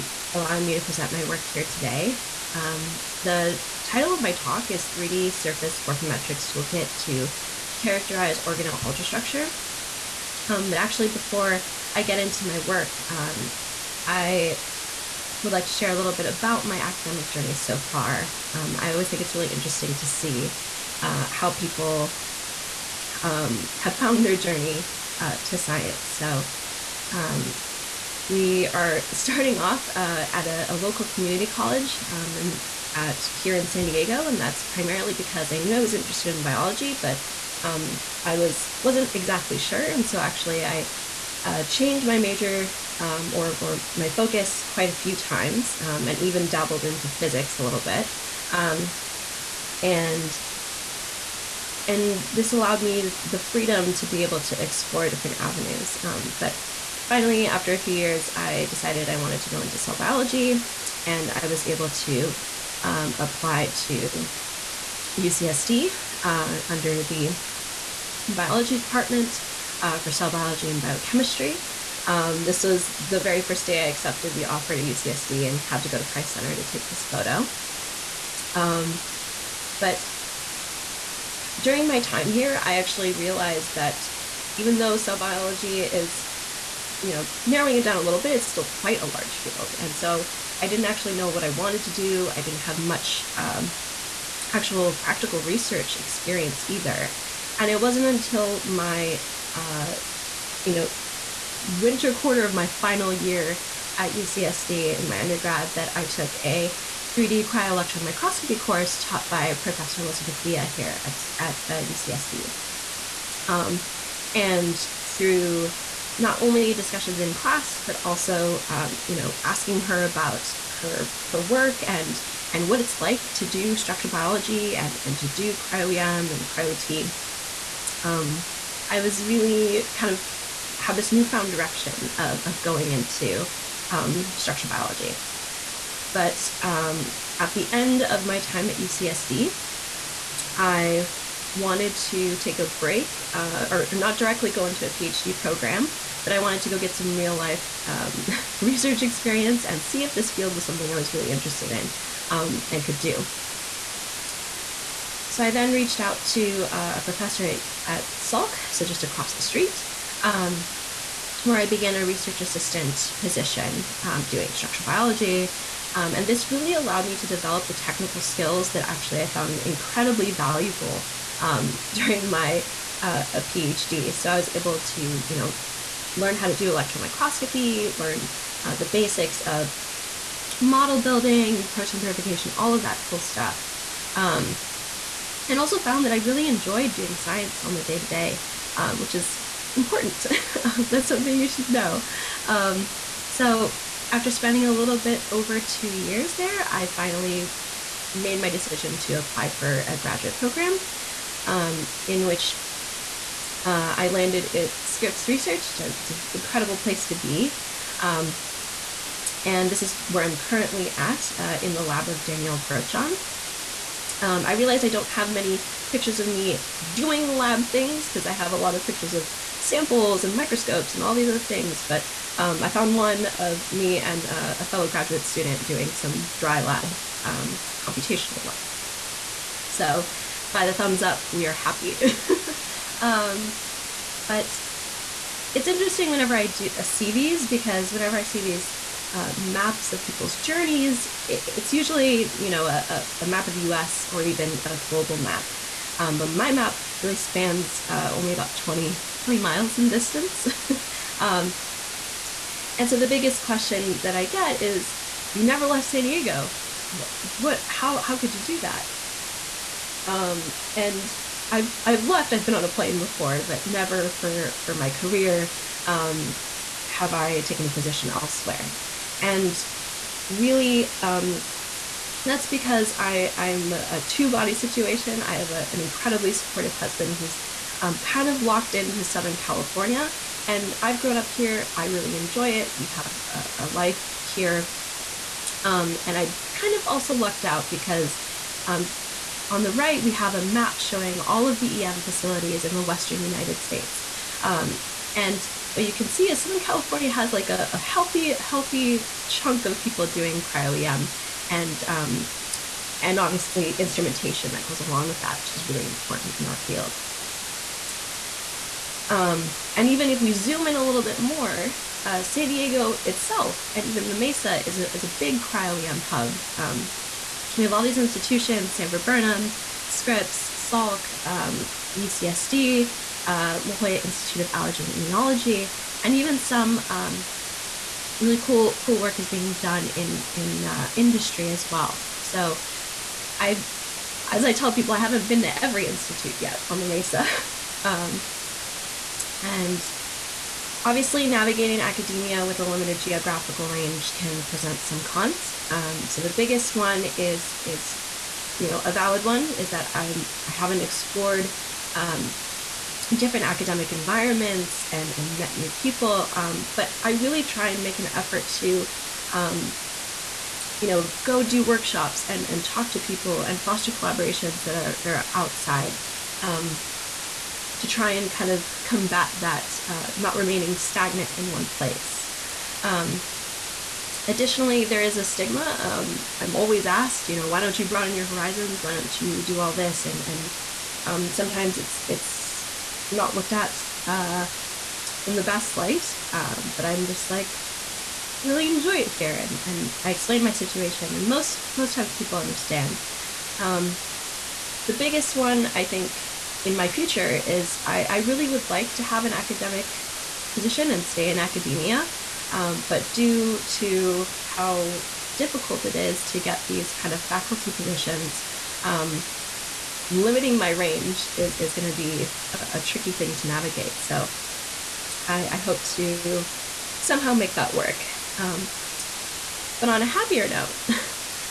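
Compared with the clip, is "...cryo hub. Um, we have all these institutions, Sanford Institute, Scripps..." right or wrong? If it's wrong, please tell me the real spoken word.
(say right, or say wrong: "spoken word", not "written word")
wrong: "Burnham", not "Institute".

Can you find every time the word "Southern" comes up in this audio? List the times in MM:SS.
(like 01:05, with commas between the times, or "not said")
04:39, 04:56.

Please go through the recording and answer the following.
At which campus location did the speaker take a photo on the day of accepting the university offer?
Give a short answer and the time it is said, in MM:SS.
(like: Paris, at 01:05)
Price Center, at 01:16.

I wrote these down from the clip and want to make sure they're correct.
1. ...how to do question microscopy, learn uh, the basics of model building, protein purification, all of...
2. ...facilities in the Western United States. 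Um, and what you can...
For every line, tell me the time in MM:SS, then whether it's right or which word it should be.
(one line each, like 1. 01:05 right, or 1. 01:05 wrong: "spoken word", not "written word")
1. 02:56 wrong: "electron", not "question"
2. 04:52 right.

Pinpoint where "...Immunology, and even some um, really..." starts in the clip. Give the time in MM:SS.
05:24.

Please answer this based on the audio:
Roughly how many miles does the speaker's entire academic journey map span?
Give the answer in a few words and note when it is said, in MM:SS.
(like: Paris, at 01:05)
20, at 04:09.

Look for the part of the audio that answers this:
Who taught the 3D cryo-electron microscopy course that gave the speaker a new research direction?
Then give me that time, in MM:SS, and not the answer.
01:50.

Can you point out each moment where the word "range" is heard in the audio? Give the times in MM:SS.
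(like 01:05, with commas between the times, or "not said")
05:43, 06:50.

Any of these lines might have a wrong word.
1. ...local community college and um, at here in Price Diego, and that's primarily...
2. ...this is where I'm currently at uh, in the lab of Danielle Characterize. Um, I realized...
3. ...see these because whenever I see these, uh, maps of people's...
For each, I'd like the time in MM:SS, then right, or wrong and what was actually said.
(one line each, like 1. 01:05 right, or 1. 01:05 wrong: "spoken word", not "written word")
1. 00:30 wrong: "San", not "Price"
2. 03:29 wrong: "Grotjahn", not "Characterize"
3. 03:56 right.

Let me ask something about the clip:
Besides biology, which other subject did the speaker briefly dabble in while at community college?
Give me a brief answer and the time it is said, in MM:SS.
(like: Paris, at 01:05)
Physics, at 00:47.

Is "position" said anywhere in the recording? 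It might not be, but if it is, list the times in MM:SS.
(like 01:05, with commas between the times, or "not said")
02:43, 04:27, 06:40, 06:47.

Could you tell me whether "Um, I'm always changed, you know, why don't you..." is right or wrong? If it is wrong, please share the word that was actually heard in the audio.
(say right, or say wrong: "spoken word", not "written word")
wrong: "asked", not "changed".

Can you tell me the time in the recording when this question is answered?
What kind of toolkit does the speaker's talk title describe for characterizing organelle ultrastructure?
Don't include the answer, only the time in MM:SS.
00:04.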